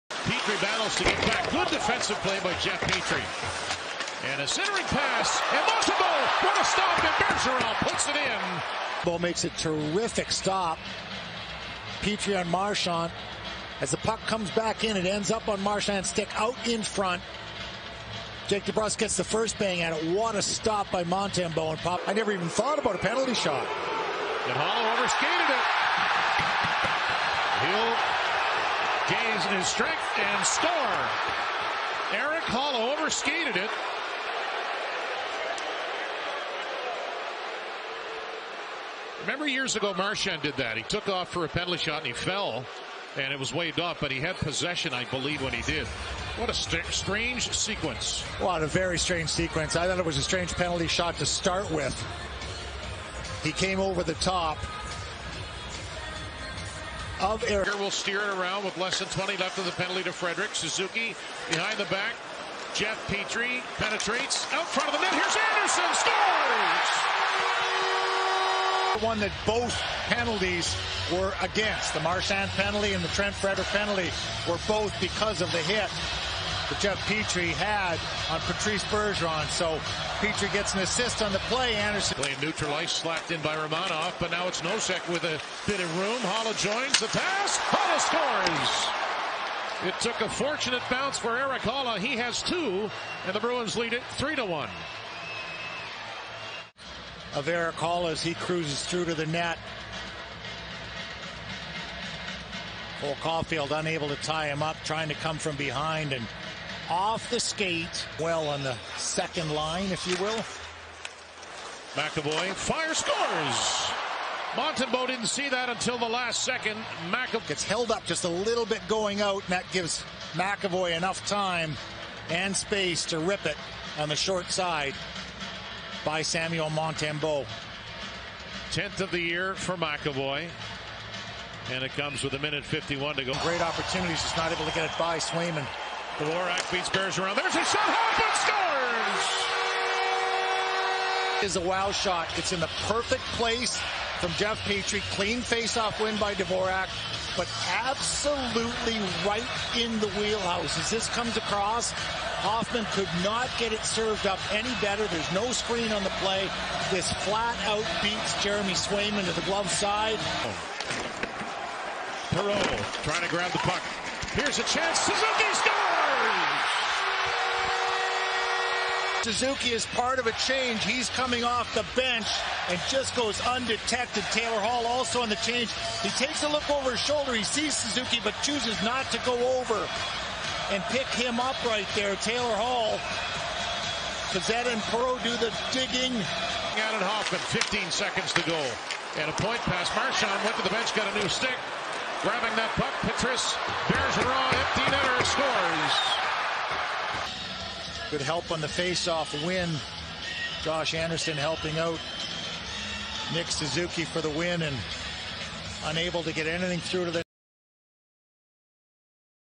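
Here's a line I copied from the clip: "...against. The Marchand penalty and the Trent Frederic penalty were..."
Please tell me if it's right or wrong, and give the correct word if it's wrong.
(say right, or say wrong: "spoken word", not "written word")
right.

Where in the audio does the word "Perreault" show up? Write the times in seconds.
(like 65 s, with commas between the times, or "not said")
162 s, 184 s.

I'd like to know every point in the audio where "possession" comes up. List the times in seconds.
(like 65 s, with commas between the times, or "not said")
44 s.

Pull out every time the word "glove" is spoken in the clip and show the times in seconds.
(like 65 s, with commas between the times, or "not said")
159 s.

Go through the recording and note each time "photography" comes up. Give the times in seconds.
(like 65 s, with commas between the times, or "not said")
not said.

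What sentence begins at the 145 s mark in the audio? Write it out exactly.
Clean face-off win by Dvorak, but absolutely right in the wheelhouse.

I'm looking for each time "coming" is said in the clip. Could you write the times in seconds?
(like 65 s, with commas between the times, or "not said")
171 s.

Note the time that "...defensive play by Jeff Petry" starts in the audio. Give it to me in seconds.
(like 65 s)
1 s.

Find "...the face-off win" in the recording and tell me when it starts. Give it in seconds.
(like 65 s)
198 s.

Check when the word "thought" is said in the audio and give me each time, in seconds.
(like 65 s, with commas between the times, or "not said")
22 s, 49 s.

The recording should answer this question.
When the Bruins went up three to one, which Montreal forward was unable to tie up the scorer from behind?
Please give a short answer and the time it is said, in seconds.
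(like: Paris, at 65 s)
Cole Caufield, at 103 s.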